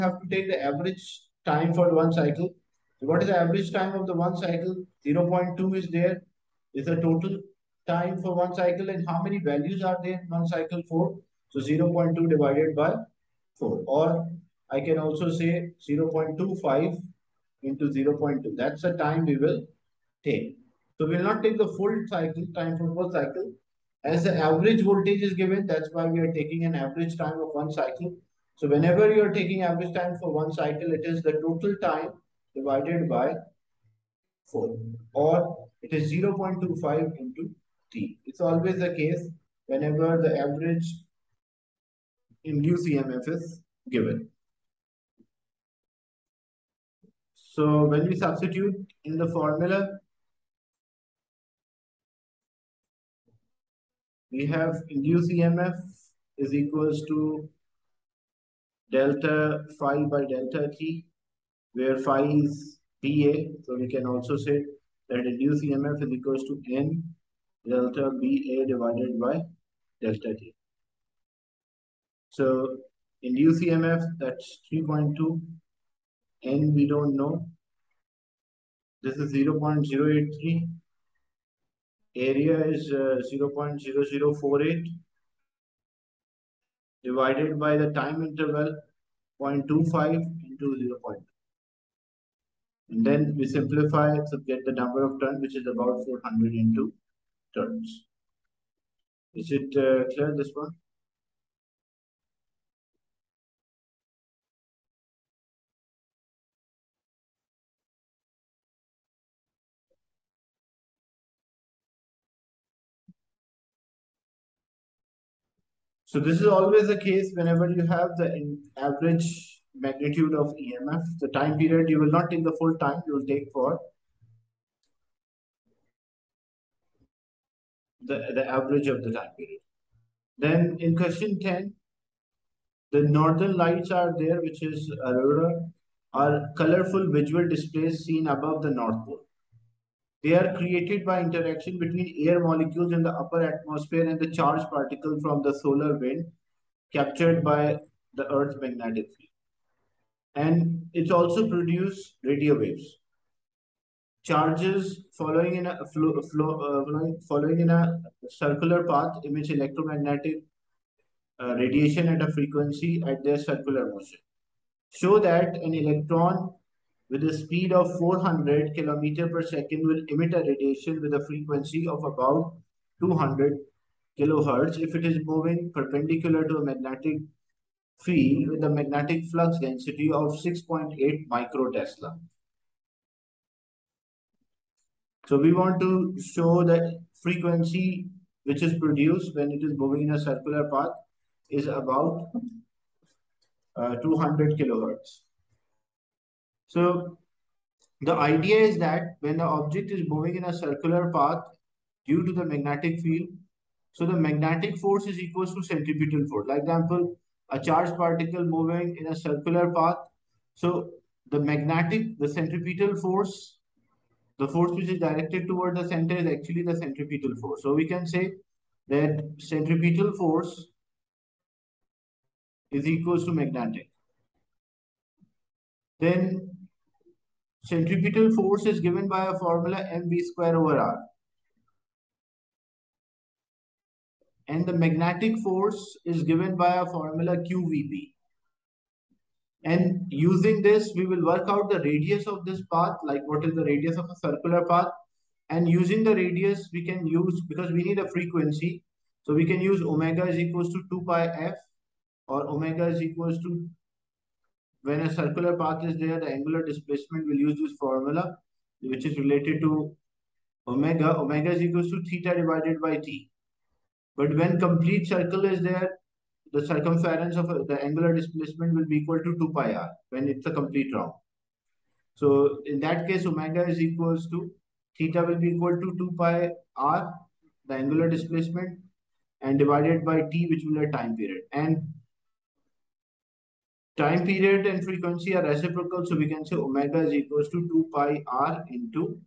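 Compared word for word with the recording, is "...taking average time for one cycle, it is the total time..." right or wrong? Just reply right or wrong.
right.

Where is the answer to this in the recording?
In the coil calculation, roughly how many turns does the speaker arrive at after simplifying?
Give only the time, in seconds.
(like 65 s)
95 s.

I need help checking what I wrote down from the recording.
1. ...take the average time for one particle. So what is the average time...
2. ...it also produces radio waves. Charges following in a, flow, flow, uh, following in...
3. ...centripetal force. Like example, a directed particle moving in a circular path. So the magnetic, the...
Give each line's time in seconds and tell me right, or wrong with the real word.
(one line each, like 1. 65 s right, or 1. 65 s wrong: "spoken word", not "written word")
1. 0 s wrong: "cycle", not "particle"
2. 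150 s right
3. 205 s wrong: "charged", not "directed".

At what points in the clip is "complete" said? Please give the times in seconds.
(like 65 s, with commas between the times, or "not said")
264 s, 270 s.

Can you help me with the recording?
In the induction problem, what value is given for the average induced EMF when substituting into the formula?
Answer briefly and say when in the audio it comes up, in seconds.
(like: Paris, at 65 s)
3.2, at 74 s.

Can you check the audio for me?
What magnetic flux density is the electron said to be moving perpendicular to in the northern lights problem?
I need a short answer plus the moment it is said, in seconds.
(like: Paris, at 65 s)
6.8 microtesla, at 180 s.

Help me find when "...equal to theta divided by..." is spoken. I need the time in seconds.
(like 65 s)
261 s.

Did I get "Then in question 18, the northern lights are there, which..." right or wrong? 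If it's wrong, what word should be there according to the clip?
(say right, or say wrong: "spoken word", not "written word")
wrong: "10", not "18".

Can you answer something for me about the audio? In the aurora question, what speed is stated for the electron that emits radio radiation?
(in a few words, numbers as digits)
400 km per second.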